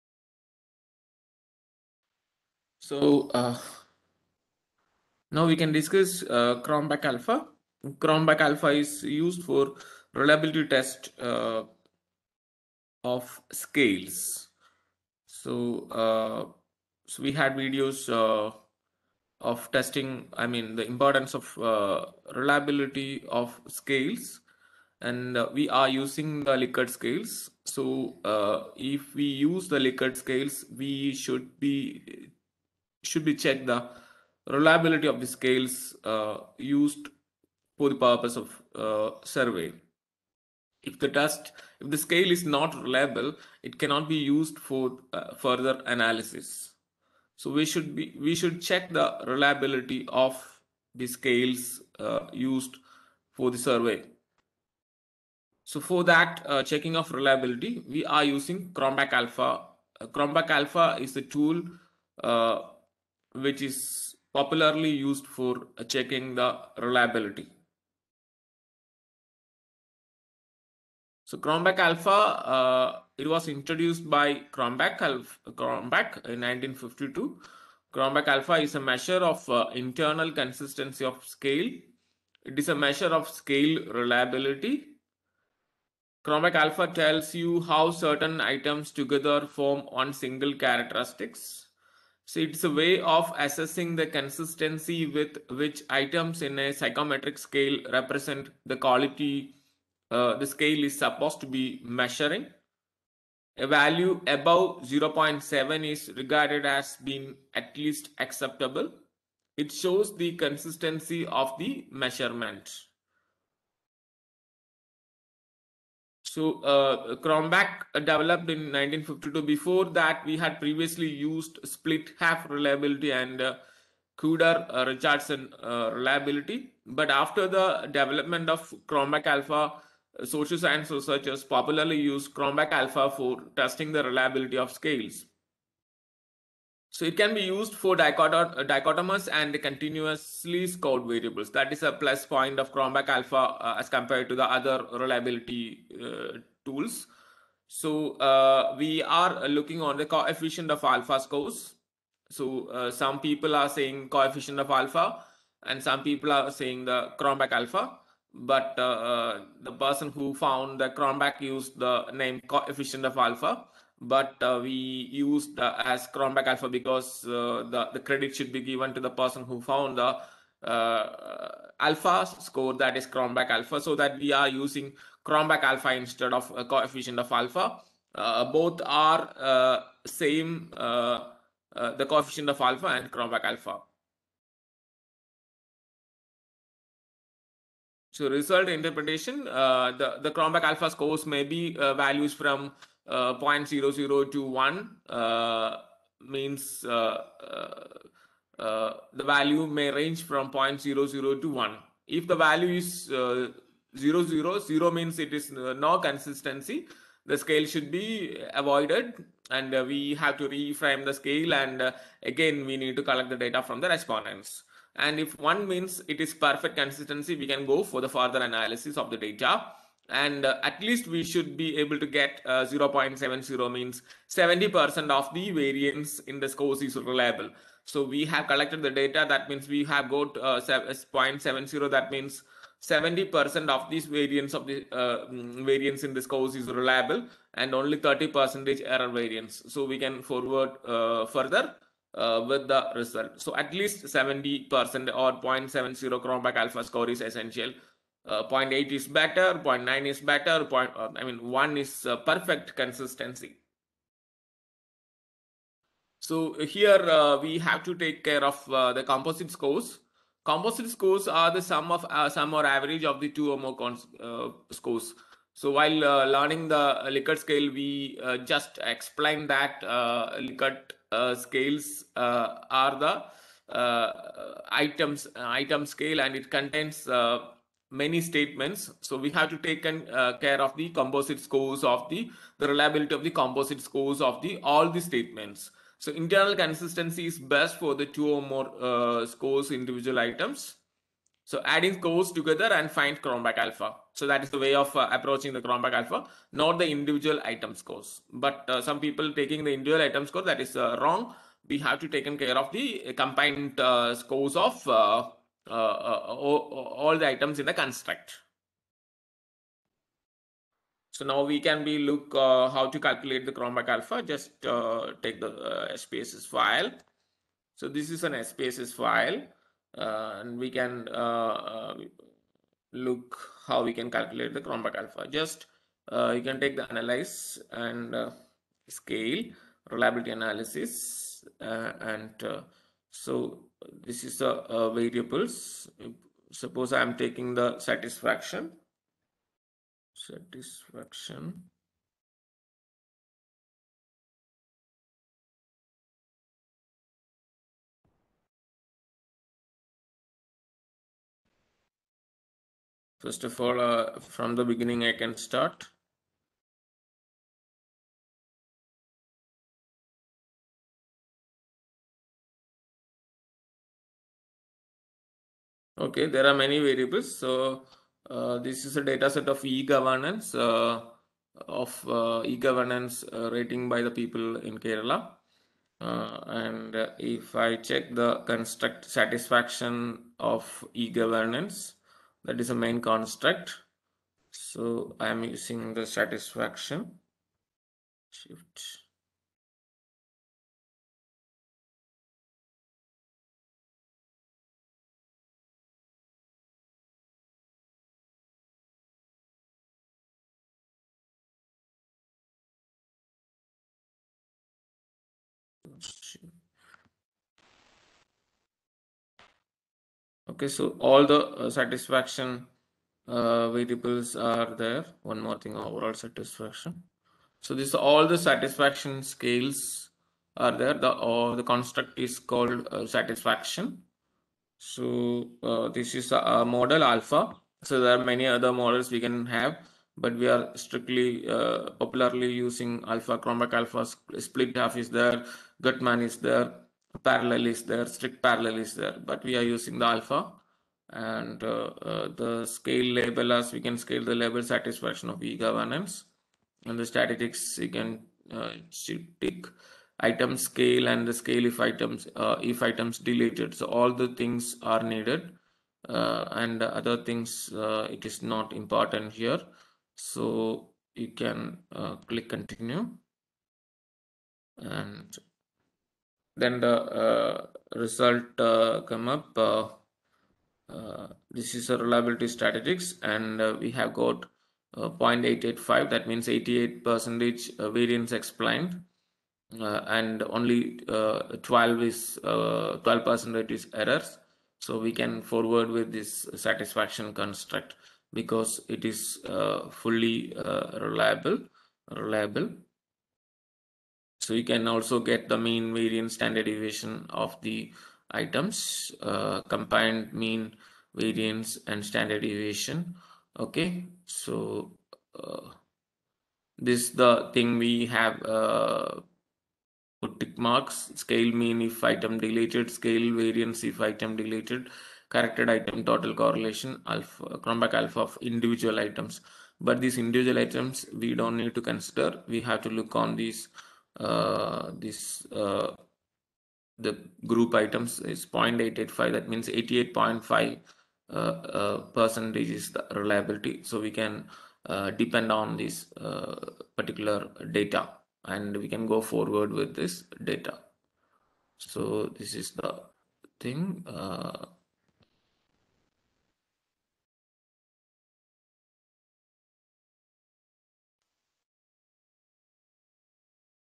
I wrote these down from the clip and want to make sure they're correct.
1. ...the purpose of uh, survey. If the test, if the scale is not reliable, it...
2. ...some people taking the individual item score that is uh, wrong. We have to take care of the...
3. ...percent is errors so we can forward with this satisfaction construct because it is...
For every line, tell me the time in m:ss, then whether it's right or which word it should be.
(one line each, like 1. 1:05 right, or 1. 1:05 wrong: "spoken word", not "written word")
1. 0:37 right
2. 4:58 right
3. 8:03 right.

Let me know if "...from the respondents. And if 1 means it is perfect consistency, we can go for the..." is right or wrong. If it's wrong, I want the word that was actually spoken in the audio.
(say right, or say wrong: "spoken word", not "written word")
right.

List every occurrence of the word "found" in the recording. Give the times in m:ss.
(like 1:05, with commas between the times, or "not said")
2:40, 2:49.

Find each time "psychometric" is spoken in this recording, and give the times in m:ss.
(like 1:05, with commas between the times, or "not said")
1:36.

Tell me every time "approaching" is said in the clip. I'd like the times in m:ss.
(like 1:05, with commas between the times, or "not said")
4:55.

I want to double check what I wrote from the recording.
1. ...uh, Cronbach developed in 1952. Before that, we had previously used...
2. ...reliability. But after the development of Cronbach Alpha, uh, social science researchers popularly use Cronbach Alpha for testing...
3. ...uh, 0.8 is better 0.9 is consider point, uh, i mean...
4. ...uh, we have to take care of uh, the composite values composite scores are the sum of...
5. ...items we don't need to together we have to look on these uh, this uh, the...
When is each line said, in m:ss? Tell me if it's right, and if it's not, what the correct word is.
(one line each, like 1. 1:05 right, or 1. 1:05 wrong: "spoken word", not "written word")
1. 1:56 right
2. 2:05 right
3. 4:08 wrong: "better", not "consider"
4. 4:17 wrong: "scores", not "values"
5. 8:40 wrong: "consider", not "together".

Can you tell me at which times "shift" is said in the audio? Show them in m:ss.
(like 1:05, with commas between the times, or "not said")
6:28.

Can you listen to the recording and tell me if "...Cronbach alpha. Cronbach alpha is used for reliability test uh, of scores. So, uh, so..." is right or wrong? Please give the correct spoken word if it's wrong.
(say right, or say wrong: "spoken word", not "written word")
wrong: "scales", not "scores".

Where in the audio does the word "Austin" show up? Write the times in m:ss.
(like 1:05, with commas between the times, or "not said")
not said.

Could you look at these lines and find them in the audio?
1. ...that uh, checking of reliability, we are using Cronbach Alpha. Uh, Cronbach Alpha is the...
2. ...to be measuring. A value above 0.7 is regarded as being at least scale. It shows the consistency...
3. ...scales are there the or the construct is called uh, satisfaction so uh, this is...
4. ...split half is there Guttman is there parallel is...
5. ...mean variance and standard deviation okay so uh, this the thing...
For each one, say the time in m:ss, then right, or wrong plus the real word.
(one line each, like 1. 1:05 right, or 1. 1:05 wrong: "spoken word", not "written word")
1. 0:56 right
2. 1:41 wrong: "acceptable", not "scale"
3. 6:59 right
4. 7:14 right
5. 8:20 right.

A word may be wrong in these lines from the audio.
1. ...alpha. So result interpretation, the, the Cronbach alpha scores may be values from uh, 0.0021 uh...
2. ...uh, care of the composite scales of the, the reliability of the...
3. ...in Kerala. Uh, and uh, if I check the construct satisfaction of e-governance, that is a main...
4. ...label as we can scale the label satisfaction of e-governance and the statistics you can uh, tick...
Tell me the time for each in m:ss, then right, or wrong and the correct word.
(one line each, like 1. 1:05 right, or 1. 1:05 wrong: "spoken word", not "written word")
1. 3:03 right
2. 4:40 wrong: "scores", not "scales"
3. 6:14 right
4. 7:23 right.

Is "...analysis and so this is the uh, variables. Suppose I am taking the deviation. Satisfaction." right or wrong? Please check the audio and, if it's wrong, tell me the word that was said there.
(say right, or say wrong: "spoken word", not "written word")
wrong: "satisfaction", not "deviation".